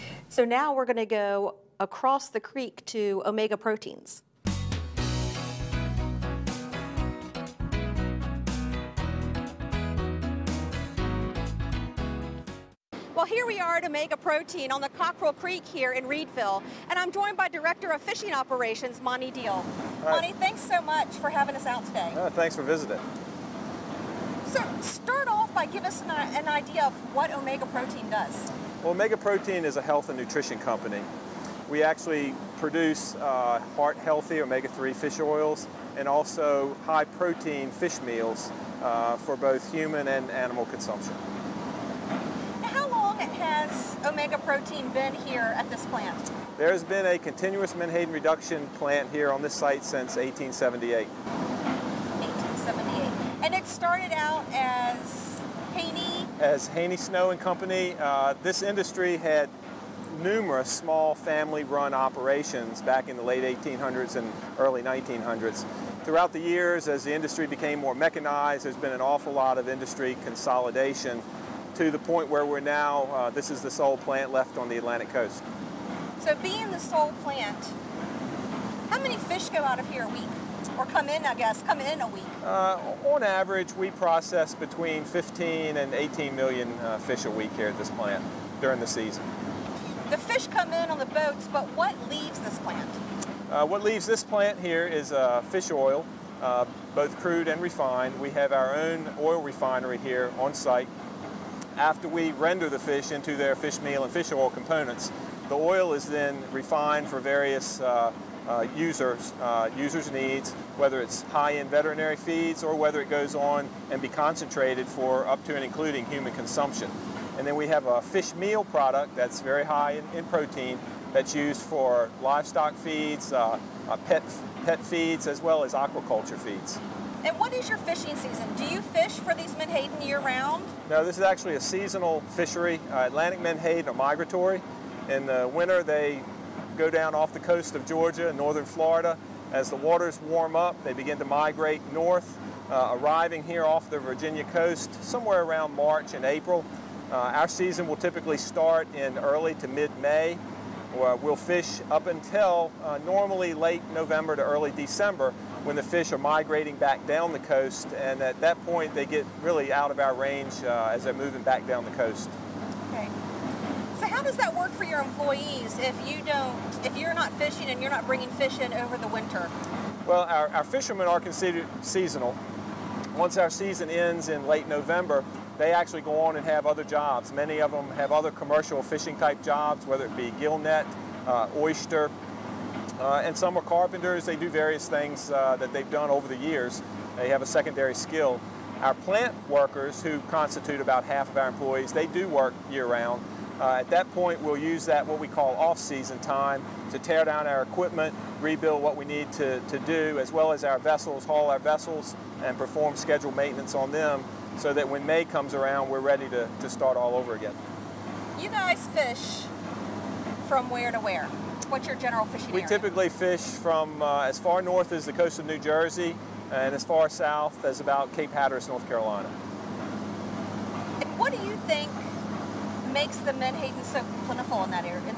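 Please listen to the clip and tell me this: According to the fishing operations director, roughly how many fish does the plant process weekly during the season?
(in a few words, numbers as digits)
15 to 18 million.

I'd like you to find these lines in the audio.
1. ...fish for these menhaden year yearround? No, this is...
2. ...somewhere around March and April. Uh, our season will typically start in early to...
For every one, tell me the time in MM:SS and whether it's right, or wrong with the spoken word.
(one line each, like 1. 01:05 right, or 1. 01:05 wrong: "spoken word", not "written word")
1. 02:08 wrong: "round", not "yearround"
2. 02:25 right.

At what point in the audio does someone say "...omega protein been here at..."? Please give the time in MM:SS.
00:44.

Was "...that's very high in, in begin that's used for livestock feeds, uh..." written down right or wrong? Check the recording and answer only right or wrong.
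wrong.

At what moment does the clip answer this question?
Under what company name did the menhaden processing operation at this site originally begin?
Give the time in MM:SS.
00:56.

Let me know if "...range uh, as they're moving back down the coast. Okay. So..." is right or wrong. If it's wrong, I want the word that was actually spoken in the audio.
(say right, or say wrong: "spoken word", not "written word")
right.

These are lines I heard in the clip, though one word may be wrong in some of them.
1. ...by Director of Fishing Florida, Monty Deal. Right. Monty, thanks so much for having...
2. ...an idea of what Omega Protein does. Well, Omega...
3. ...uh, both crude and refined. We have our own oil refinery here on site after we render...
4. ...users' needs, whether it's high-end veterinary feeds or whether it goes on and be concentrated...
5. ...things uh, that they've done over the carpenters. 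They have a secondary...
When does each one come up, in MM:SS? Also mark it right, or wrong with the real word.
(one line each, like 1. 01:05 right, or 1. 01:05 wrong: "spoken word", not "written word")
1. 00:17 wrong: "Operations", not "Florida"
2. 00:26 right
3. 01:36 right
4. 01:49 right
5. 03:04 wrong: "years", not "carpenters".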